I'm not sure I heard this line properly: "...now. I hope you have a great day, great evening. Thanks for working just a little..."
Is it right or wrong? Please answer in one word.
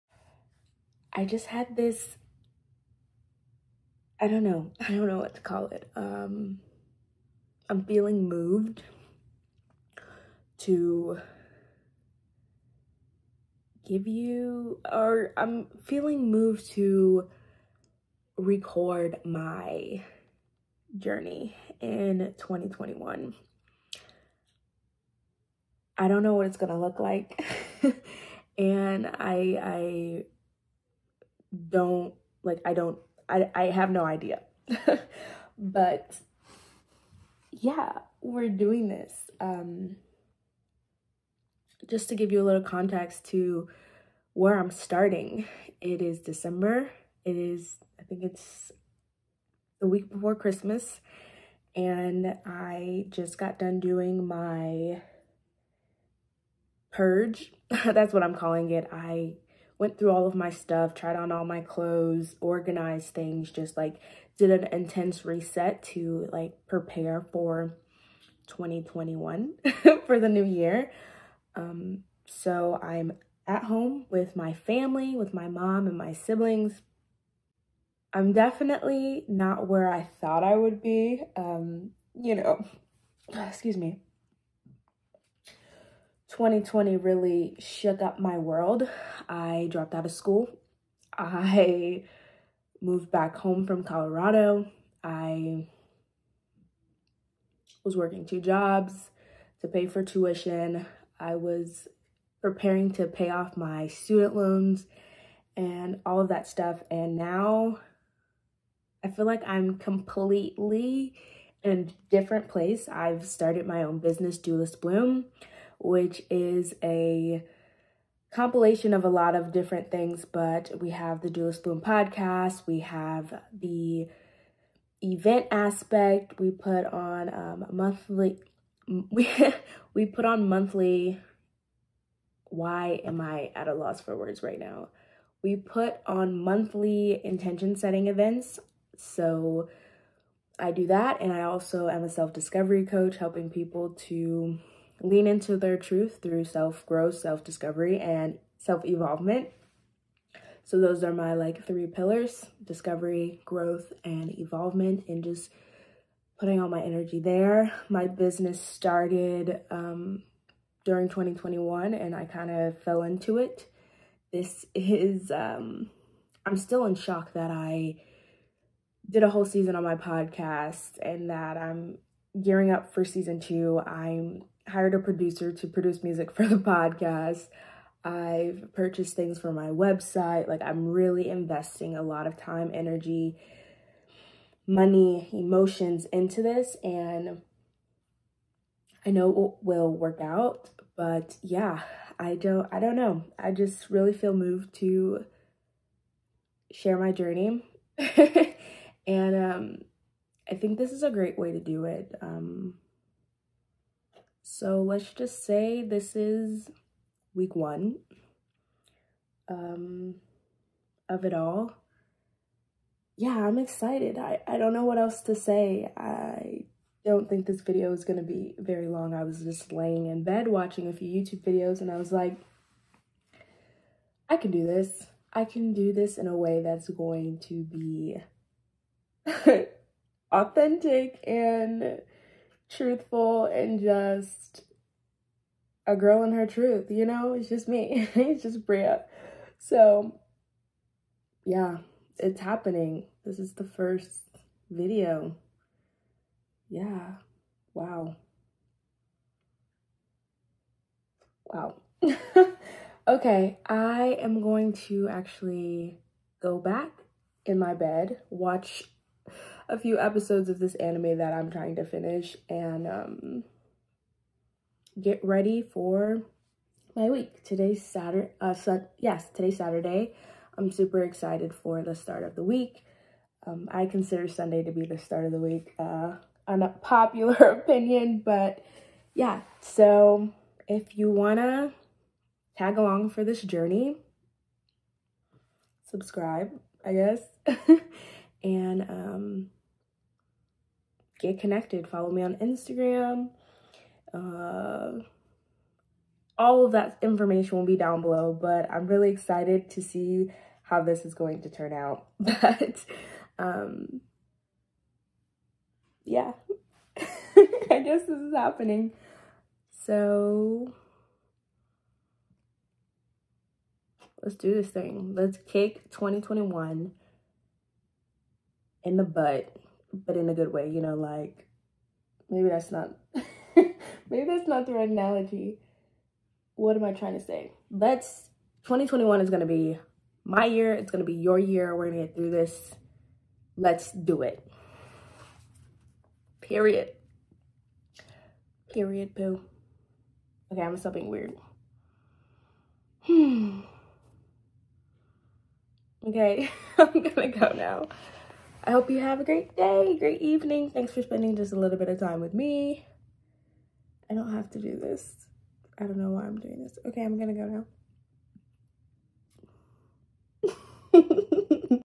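wrong.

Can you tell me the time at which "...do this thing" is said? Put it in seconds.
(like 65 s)
314 s.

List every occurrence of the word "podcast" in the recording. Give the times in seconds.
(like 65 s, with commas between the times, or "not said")
121 s, 169 s, 176 s.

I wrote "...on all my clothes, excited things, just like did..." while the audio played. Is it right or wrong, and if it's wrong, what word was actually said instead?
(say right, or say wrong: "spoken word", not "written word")
wrong: "organized", not "excited".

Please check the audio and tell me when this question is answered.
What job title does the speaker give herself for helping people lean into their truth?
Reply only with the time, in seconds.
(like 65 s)
142 s.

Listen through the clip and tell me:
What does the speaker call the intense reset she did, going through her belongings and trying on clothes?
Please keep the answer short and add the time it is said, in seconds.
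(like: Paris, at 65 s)
Purge, at 56 s.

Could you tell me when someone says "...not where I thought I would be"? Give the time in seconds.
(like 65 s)
79 s.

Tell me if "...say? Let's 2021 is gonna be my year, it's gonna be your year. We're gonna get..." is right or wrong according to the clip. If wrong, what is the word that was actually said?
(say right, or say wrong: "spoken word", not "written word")
right.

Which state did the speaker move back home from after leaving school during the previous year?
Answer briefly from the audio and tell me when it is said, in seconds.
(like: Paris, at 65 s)
Colorado, at 93 s.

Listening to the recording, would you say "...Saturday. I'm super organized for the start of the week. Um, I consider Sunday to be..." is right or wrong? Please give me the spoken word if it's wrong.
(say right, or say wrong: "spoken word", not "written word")
wrong: "excited", not "organized".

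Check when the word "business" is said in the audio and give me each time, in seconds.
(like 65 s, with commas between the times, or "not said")
113 s, 158 s.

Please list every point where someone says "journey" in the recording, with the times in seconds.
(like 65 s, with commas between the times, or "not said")
20 s, 197 s, 283 s.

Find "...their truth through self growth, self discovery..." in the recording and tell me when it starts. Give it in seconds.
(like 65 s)
145 s.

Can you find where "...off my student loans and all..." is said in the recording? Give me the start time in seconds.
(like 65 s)
103 s.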